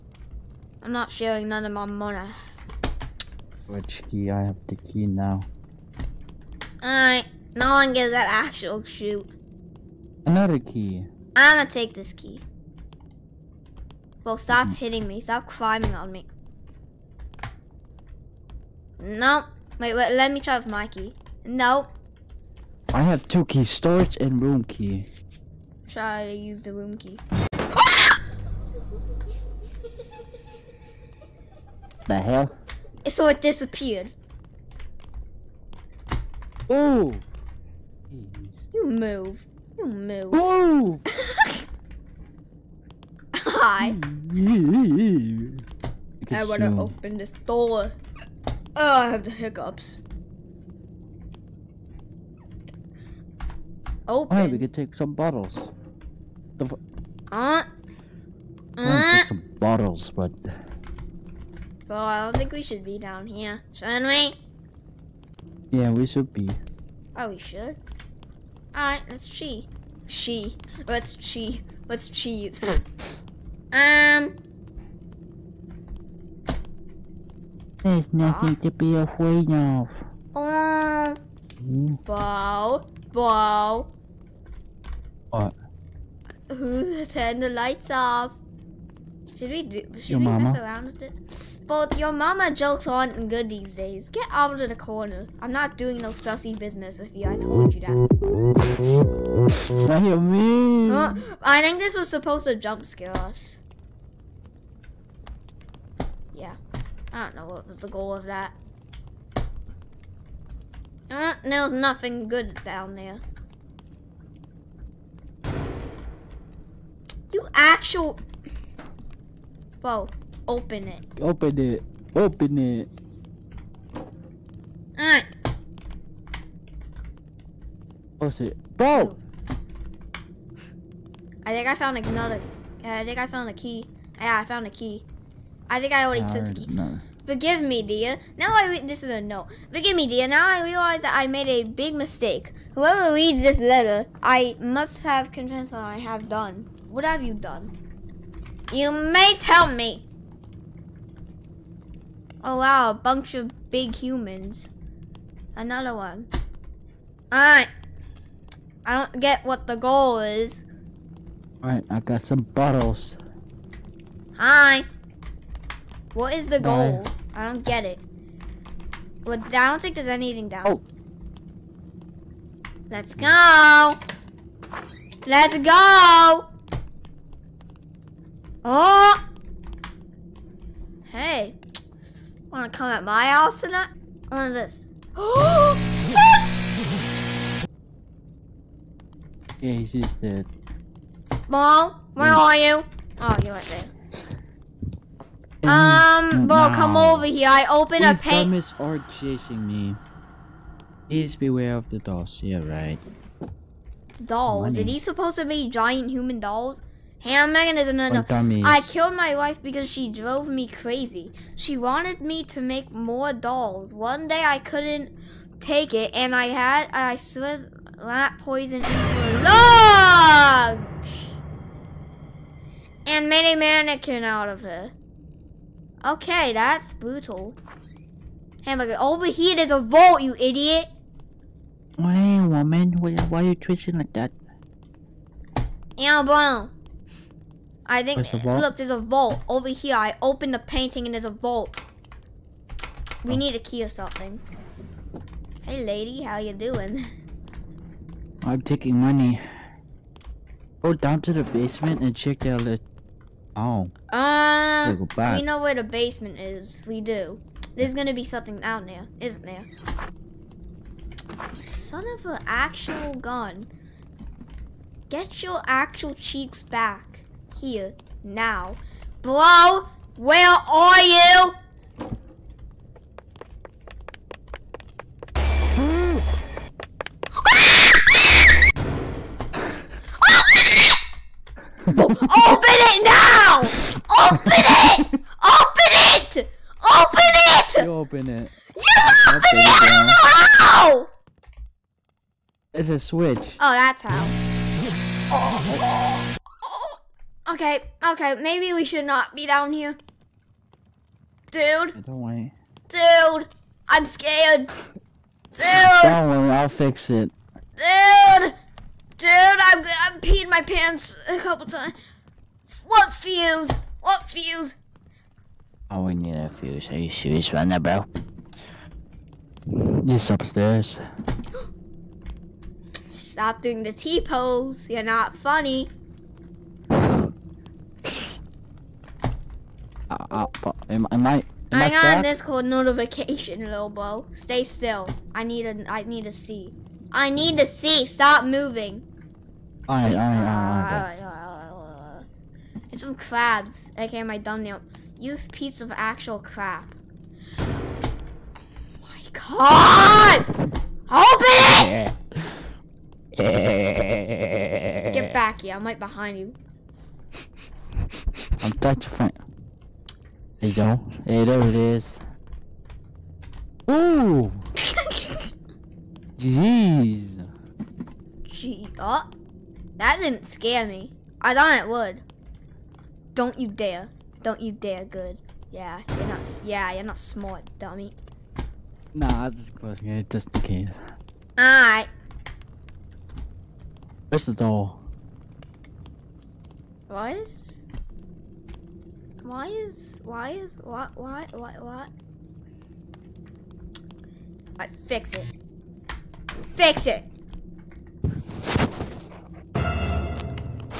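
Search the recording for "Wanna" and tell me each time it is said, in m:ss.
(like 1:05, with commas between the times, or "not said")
3:02.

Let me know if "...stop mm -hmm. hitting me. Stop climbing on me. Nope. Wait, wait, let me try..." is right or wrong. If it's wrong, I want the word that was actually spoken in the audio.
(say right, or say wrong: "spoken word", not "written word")
right.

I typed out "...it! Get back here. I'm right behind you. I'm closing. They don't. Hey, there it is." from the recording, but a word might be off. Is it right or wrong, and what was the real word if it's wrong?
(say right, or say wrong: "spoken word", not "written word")
wrong: "touching", not "closing".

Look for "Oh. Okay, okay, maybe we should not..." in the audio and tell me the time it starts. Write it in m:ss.
4:55.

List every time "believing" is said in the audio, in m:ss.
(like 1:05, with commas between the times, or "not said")
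not said.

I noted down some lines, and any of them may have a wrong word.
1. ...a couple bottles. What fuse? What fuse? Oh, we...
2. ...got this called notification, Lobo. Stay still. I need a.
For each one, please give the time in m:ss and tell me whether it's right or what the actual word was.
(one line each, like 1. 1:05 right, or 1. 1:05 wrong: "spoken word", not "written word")
1. 5:11 wrong: "times", not "bottles"
2. 5:31 right.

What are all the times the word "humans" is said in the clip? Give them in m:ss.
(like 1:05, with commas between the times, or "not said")
2:33, 3:26.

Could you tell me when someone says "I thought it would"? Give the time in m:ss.
6:11.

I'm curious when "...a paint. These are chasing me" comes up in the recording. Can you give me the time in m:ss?
3:18.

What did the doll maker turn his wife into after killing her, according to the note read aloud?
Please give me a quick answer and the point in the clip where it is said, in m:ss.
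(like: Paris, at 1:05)
A mannequin, at 3:43.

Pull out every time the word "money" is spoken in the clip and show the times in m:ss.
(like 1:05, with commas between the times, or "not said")
0:01, 3:24, 4:08.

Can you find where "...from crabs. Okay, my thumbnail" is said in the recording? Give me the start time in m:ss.
5:43.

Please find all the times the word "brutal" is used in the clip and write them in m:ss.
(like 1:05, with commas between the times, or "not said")
3:46.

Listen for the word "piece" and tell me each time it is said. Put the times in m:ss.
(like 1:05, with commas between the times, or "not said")
5:45.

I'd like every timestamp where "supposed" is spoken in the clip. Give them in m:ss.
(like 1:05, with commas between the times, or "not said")
1:42, 3:25.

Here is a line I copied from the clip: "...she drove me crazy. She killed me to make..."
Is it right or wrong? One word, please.
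wrong.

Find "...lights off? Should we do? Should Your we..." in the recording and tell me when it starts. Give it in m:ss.
1:27.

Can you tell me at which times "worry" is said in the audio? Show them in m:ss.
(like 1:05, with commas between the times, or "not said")
5:02, 5:06.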